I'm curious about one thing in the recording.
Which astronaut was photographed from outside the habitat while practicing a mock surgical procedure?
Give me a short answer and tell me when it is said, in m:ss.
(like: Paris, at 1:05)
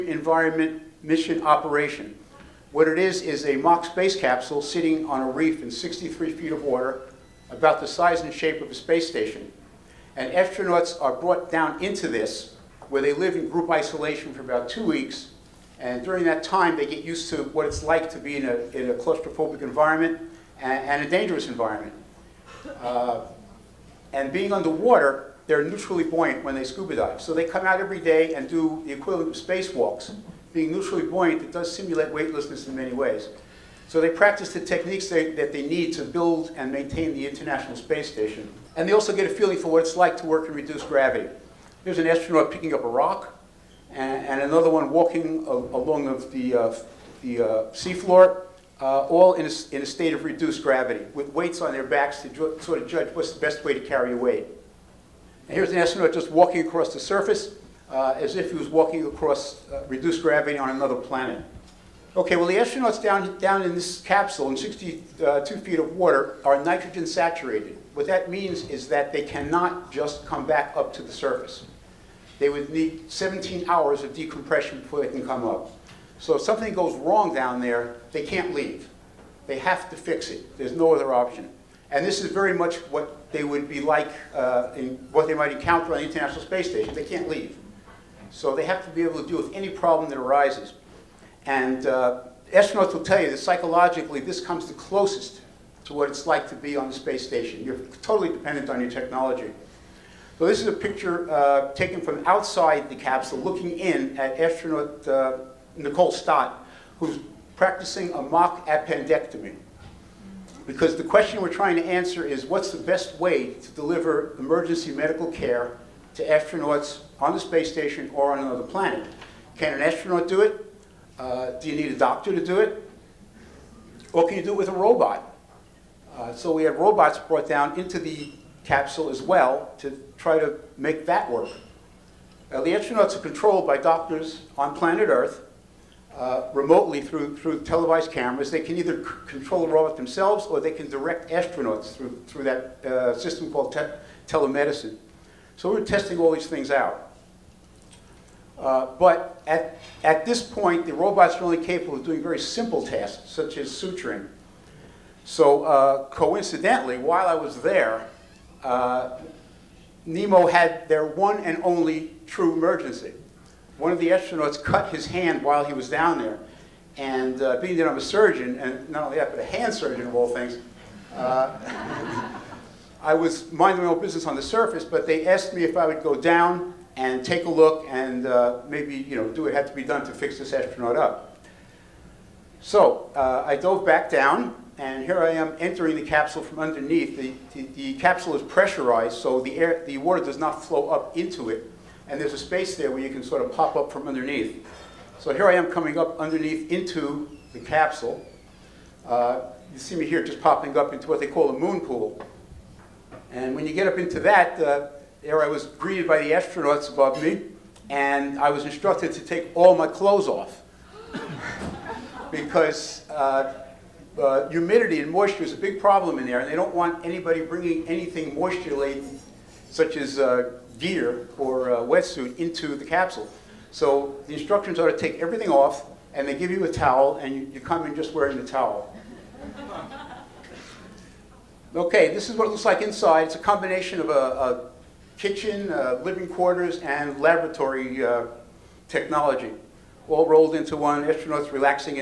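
Nicole Stott, at 1:45.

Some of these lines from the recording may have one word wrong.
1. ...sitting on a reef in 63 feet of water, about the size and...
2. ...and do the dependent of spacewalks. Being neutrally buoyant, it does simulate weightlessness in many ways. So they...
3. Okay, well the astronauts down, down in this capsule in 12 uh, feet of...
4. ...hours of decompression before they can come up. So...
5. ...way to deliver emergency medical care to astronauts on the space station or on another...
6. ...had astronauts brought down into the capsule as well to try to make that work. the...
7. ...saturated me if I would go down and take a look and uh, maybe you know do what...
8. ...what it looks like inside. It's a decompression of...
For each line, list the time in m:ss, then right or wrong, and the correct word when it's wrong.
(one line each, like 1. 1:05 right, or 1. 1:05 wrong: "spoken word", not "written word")
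1. 0:04 right
2. 0:28 wrong: "equivalent", not "dependent"
3. 1:02 wrong: "62", not "12"
4. 1:13 right
5. 1:53 right
6. 2:06 wrong: "robots", not "astronauts"
7. 2:55 wrong: "asked", not "saturated"
8. 3:52 wrong: "combination", not "decompression".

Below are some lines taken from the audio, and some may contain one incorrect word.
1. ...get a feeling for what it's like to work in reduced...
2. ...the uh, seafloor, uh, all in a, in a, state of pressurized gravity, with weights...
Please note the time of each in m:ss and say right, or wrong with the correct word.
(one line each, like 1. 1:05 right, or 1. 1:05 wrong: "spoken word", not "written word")
1. 0:39 right
2. 0:47 wrong: "reduced", not "pressurized".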